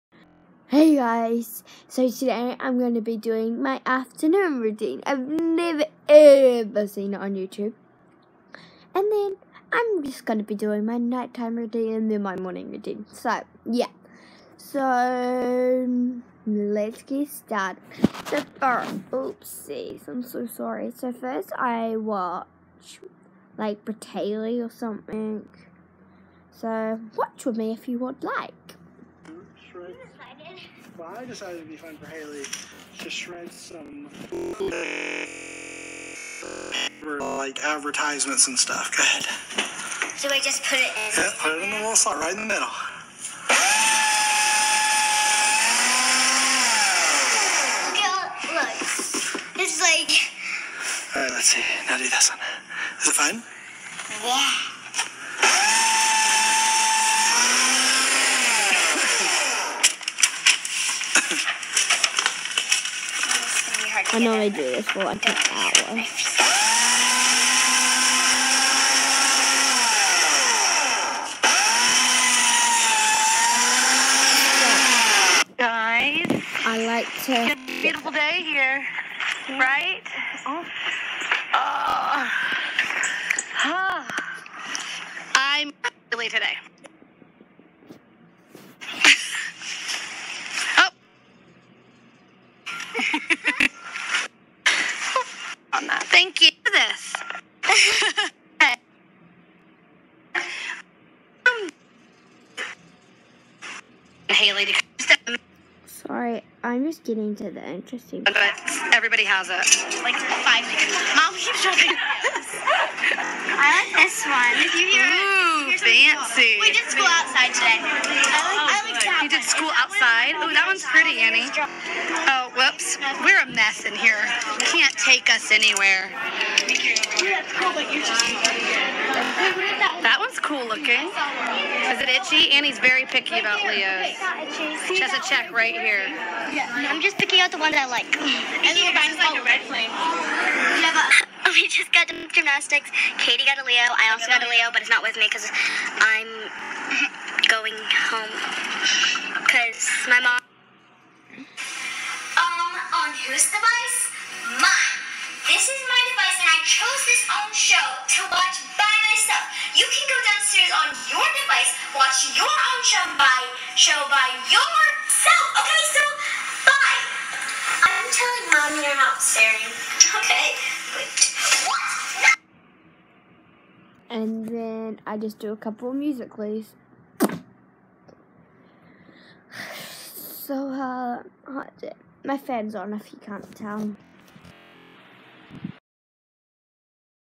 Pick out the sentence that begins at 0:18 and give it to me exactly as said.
So, first, oopsies, I'm so sorry.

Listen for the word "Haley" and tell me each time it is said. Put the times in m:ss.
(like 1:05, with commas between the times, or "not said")
0:32, 1:44.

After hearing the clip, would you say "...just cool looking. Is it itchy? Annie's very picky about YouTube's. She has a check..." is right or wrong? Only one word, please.
wrong.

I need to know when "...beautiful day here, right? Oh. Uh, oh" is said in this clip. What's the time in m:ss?
1:17.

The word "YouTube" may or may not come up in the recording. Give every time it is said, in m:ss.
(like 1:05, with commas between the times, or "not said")
0:07.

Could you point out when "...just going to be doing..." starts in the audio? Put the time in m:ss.
0:10.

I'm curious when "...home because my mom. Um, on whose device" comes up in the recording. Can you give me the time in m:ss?
2:28.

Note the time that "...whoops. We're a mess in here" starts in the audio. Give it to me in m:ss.
2:02.